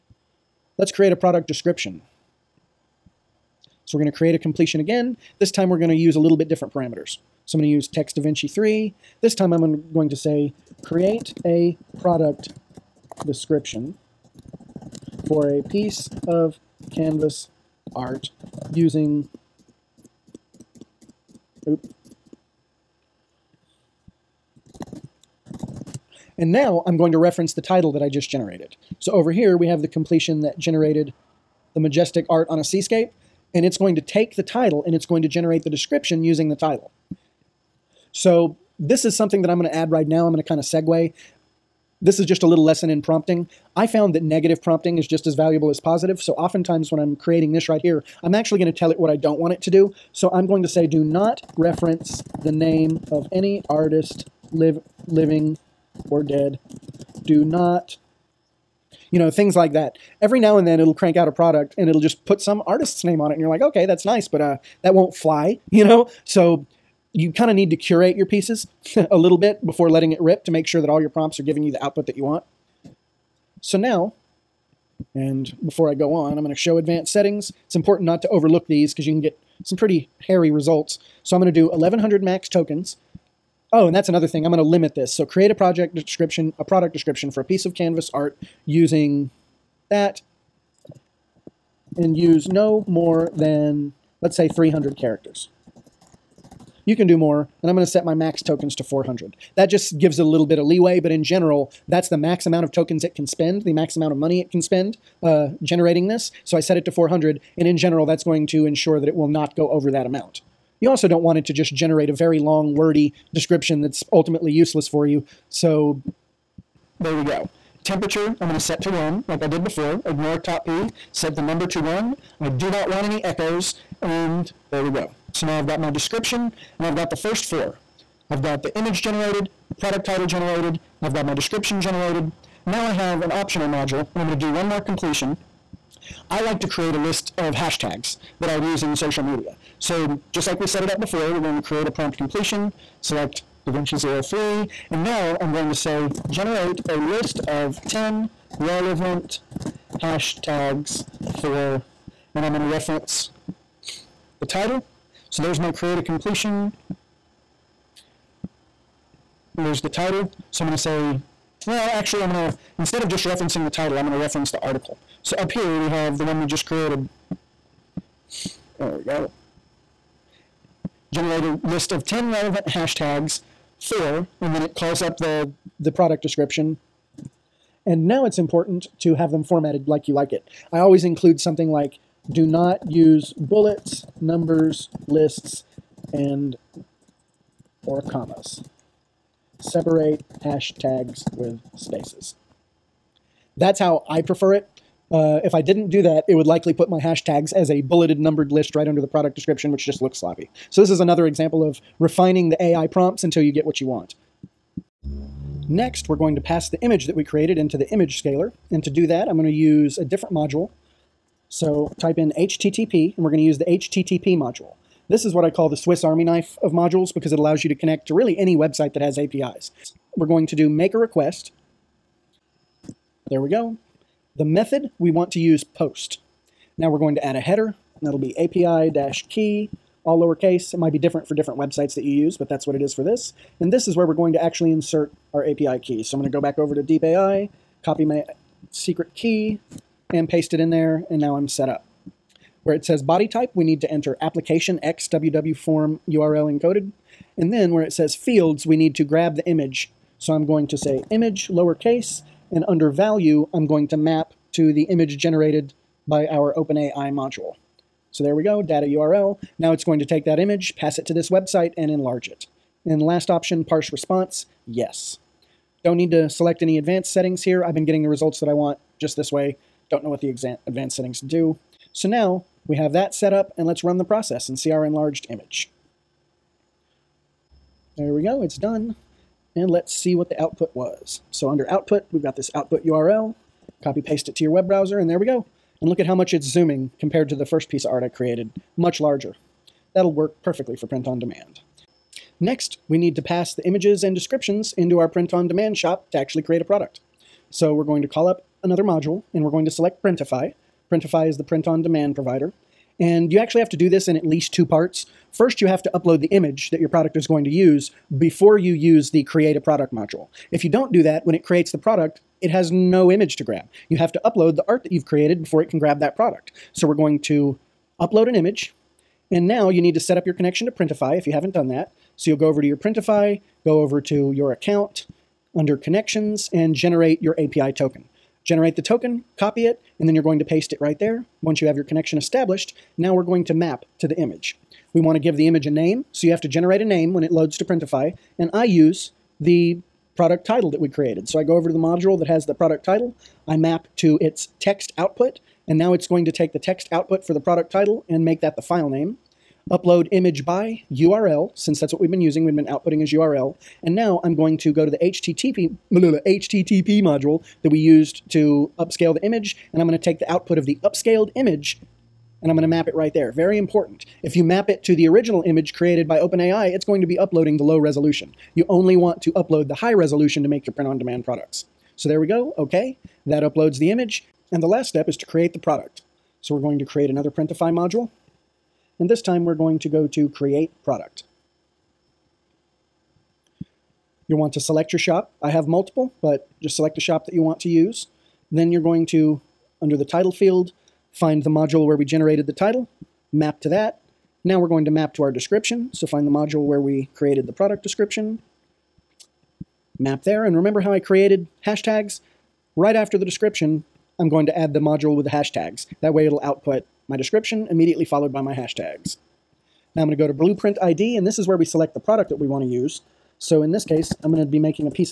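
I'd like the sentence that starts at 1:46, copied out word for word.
So I set it to 400, and in general, that's going to ensure that it will not go over that amount.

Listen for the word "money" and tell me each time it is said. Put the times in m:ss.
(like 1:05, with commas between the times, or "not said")
1:44.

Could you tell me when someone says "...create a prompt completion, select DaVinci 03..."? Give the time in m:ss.
2:21.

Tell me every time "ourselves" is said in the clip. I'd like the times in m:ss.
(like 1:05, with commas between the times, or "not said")
not said.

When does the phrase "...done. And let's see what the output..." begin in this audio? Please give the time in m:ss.
4:38.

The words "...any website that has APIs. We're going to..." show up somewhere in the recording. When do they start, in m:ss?
3:38.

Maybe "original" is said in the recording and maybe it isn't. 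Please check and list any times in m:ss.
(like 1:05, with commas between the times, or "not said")
6:05.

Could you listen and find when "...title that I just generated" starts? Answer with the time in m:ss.
0:27.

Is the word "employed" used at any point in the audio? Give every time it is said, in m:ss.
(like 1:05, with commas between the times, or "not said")
not said.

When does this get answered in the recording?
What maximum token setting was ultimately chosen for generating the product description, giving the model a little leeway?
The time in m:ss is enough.
1:37.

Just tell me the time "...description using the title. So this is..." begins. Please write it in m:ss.
0:35.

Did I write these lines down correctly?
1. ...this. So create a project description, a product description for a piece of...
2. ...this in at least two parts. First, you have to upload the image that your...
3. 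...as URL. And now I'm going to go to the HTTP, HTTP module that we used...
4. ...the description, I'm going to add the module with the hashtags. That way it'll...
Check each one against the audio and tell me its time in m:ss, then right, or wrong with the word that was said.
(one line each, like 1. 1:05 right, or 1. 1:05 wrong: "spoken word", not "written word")
1. 1:24 right
2. 5:03 right
3. 5:53 right
4. 6:43 right.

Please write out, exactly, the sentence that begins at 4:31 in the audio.
So now we have that set up and let's run the process and see our enlarged image.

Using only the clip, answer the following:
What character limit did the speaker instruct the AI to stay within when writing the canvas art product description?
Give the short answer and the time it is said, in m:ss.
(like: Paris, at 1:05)
300 characters, at 1:34.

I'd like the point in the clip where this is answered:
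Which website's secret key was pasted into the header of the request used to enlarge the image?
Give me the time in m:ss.
3:56.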